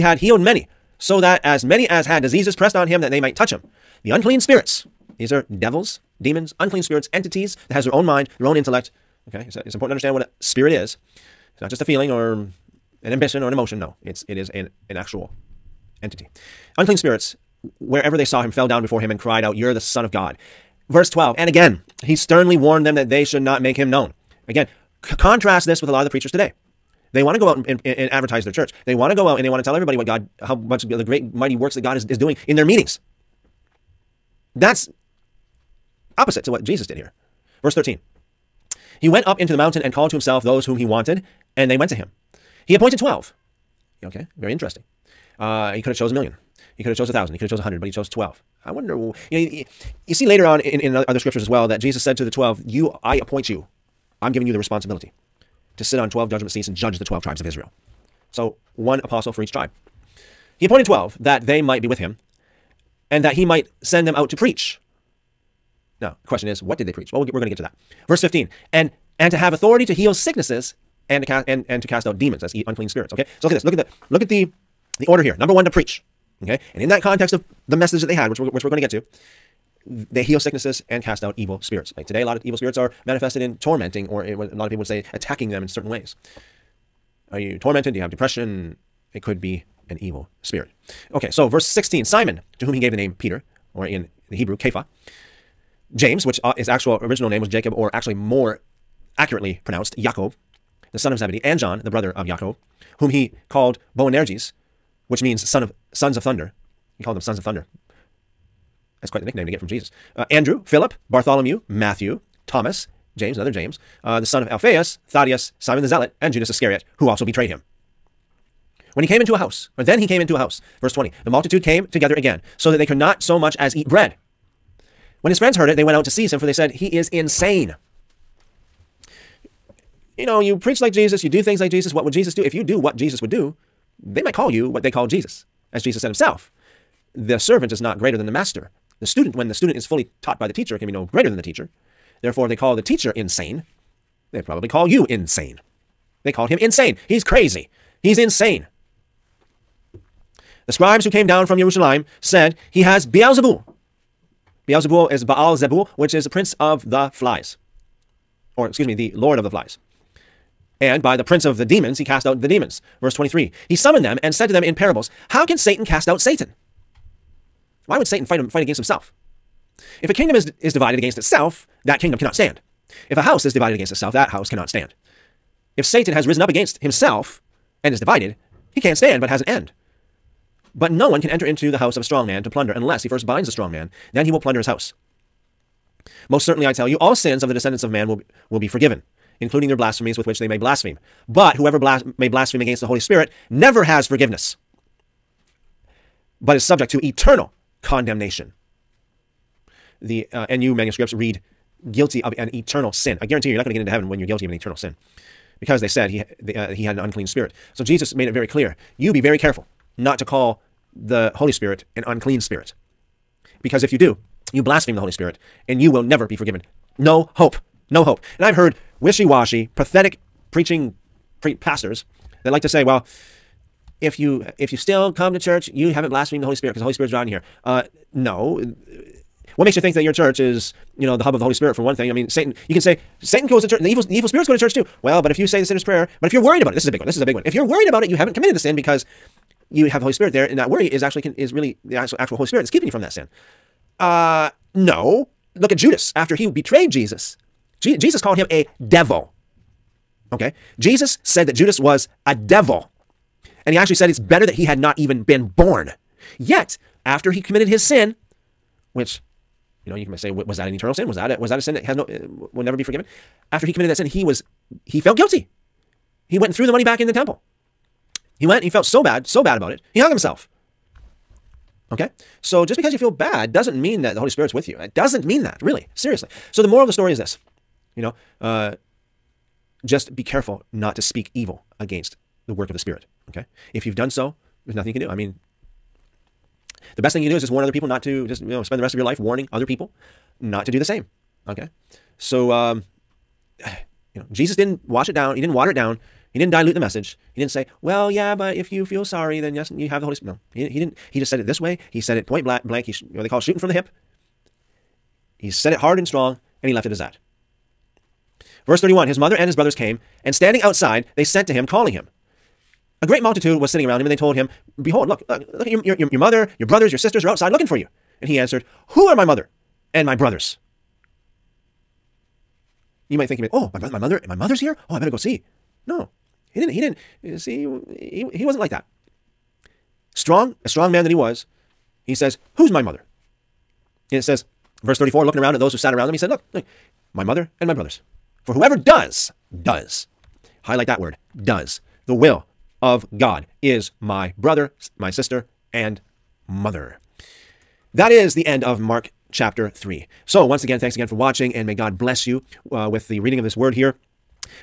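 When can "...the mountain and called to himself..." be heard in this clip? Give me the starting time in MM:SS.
00:39.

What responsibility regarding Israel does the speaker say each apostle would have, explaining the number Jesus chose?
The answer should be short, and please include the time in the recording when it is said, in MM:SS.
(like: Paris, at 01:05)
Judge the twelve tribes, at 00:56.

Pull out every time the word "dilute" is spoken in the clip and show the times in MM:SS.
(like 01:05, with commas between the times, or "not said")
04:56.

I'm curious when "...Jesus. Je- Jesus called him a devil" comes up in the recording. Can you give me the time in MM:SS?
04:06.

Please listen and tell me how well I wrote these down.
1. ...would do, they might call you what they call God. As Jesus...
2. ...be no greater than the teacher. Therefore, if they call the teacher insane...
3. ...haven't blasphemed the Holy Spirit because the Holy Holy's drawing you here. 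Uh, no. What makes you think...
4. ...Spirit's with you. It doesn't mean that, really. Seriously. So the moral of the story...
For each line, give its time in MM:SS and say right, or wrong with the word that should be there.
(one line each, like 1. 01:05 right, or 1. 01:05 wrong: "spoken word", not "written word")
1. 02:13 wrong: "Jesus", not "God"
2. 02:20 right
3. 03:45 wrong: "Spirit", not "Holy"
4. 04:34 right.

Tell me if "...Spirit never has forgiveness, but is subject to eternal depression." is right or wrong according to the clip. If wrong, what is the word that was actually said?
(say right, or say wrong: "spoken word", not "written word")
wrong: "condemnation", not "depression".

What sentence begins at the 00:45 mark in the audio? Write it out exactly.
Uh, he could have chose a million.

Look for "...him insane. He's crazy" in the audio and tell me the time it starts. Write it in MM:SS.
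02:26.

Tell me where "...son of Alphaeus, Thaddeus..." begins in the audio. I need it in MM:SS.
01:54.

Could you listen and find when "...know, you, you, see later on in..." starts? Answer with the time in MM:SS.
00:49.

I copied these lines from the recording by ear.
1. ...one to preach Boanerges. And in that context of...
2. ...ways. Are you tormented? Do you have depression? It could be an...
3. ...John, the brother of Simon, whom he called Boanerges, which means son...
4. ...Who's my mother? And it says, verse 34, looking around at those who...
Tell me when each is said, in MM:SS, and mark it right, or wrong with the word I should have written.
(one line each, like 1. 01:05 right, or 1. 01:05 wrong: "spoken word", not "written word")
1. 01:15 wrong: "Okay", not "Boanerges"
2. 01:25 right
3. 01:41 wrong: "Jacob", not "Simon"
4. 05:32 right.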